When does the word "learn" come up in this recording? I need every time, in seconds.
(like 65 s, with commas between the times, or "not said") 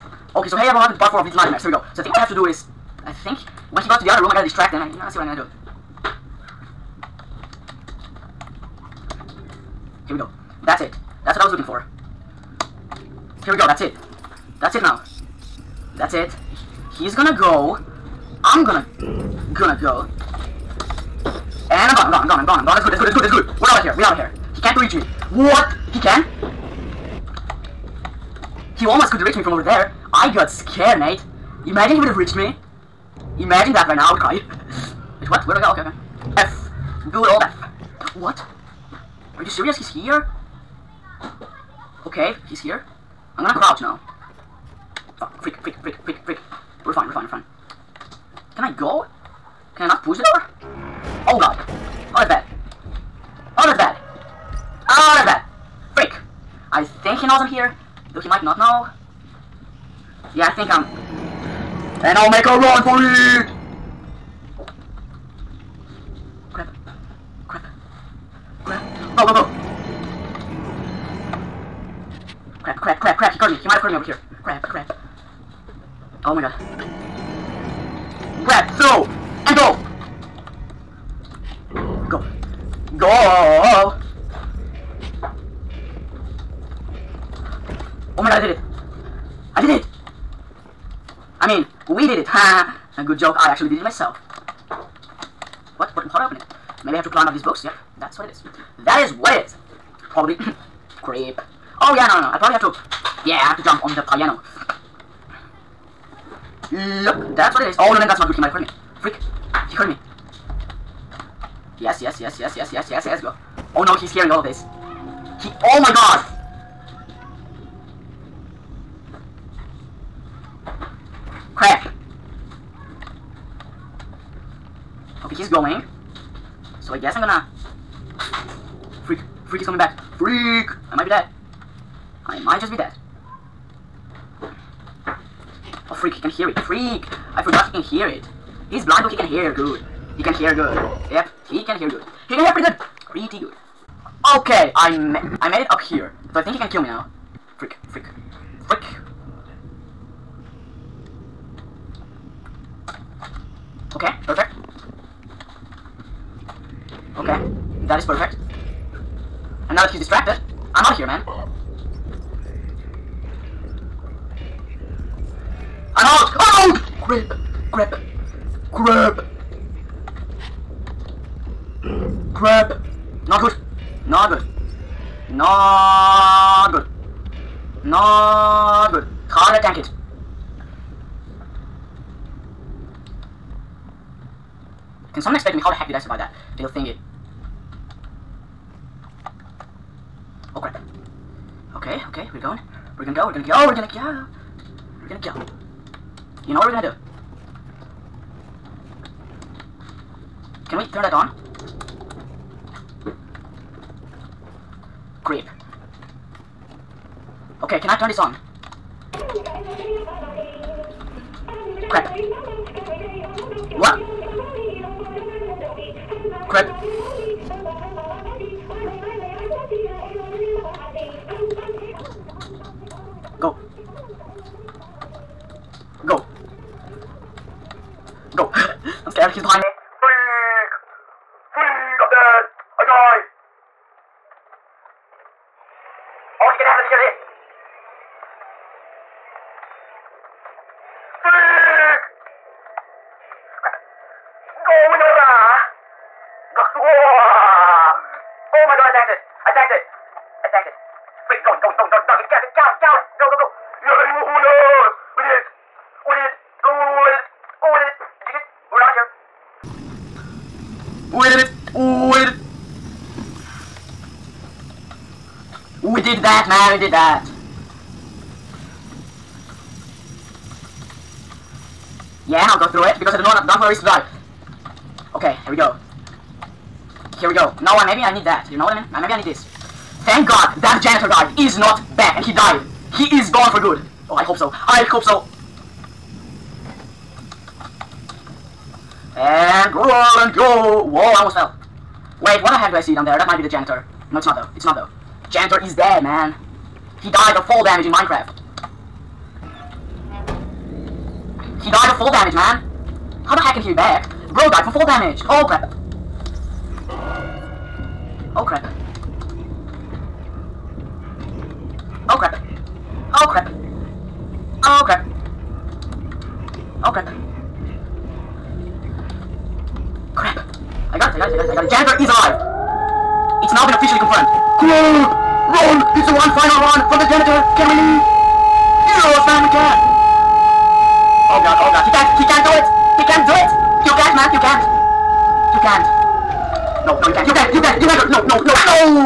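not said.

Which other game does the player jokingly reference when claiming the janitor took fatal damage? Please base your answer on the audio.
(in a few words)
Minecraft.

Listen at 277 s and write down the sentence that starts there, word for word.
No, I, maybe I need that.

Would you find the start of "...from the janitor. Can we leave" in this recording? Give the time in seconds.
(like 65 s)
326 s.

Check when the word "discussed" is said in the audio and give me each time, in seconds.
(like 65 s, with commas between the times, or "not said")
not said.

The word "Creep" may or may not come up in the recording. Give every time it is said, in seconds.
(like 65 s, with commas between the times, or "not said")
101 s, 205 s.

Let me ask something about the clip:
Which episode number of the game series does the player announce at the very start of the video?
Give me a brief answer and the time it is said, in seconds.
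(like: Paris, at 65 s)
4, at 0 s.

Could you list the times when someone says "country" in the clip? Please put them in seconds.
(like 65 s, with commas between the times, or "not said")
not said.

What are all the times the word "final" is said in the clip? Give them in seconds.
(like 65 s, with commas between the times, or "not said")
326 s.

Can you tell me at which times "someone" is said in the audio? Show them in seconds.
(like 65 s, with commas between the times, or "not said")
185 s.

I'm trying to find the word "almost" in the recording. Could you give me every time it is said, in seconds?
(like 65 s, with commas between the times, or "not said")
28 s, 291 s.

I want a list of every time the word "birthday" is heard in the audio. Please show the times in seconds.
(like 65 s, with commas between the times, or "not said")
not said.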